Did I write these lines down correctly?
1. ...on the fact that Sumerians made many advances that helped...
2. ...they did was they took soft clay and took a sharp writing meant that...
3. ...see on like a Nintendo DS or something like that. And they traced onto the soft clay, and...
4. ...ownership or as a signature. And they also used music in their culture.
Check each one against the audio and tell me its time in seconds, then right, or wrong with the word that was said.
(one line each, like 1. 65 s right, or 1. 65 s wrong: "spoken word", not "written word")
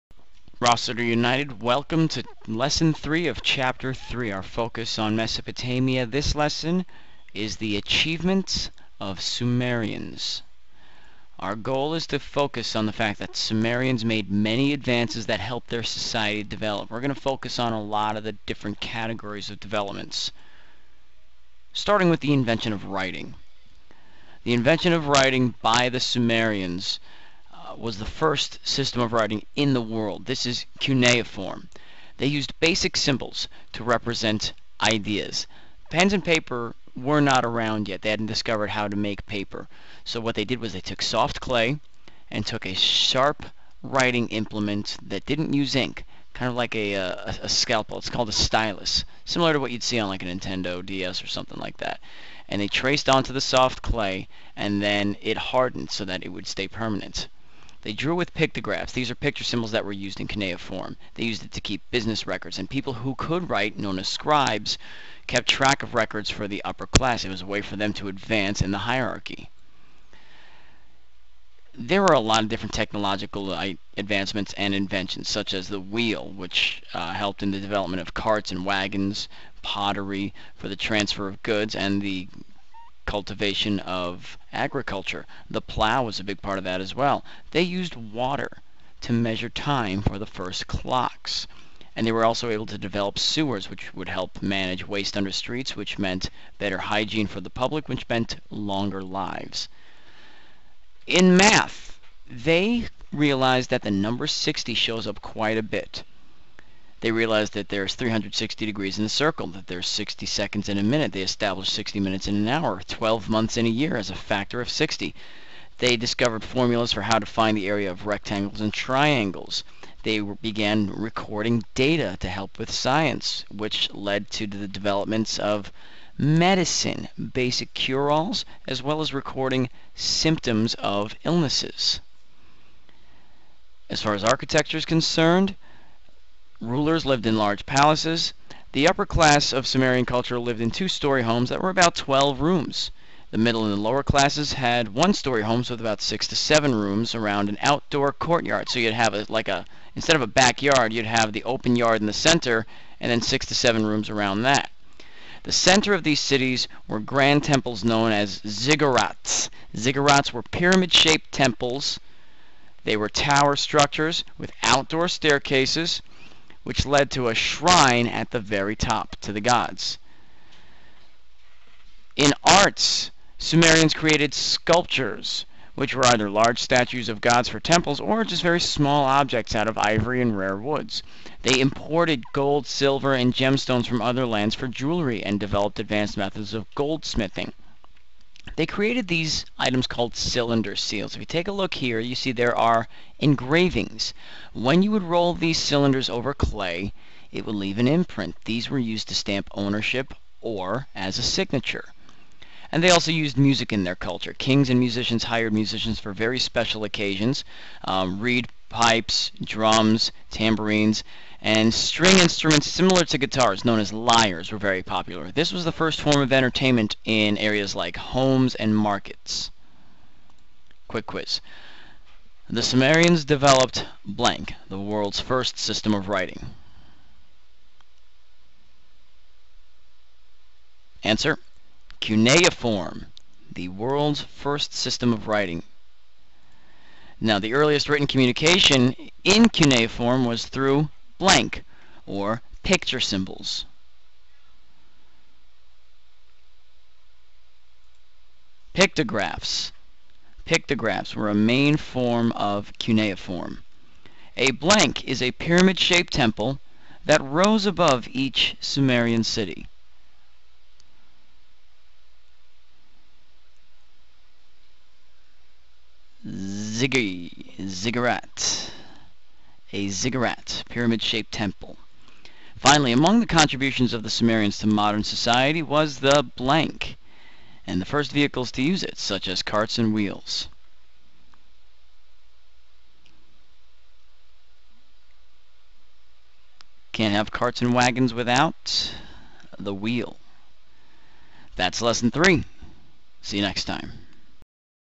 1. 12 s right
2. 40 s wrong: "implement", not "meant"
3. 49 s right
4. 199 s right.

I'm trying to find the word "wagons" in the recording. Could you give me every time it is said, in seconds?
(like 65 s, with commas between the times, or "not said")
78 s, 287 s.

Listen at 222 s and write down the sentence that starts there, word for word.
The Sumerians developed blank, the world's first system of writing.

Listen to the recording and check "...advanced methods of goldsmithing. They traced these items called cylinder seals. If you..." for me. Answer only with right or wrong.
wrong.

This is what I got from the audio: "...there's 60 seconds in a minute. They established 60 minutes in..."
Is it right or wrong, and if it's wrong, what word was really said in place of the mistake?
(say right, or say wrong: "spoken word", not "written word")
right.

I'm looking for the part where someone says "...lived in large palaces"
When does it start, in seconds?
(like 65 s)
137 s.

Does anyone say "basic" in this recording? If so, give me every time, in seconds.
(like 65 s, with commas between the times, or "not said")
32 s, 127 s.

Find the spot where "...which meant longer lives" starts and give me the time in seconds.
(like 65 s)
97 s.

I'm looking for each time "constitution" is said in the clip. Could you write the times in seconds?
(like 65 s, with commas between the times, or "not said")
not said.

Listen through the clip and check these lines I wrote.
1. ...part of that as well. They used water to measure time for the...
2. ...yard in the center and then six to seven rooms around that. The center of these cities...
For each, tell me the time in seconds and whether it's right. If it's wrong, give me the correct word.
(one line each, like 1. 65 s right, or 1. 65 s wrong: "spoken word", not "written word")
1. 86 s right
2. 151 s right.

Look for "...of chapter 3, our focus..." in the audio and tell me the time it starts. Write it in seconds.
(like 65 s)
3 s.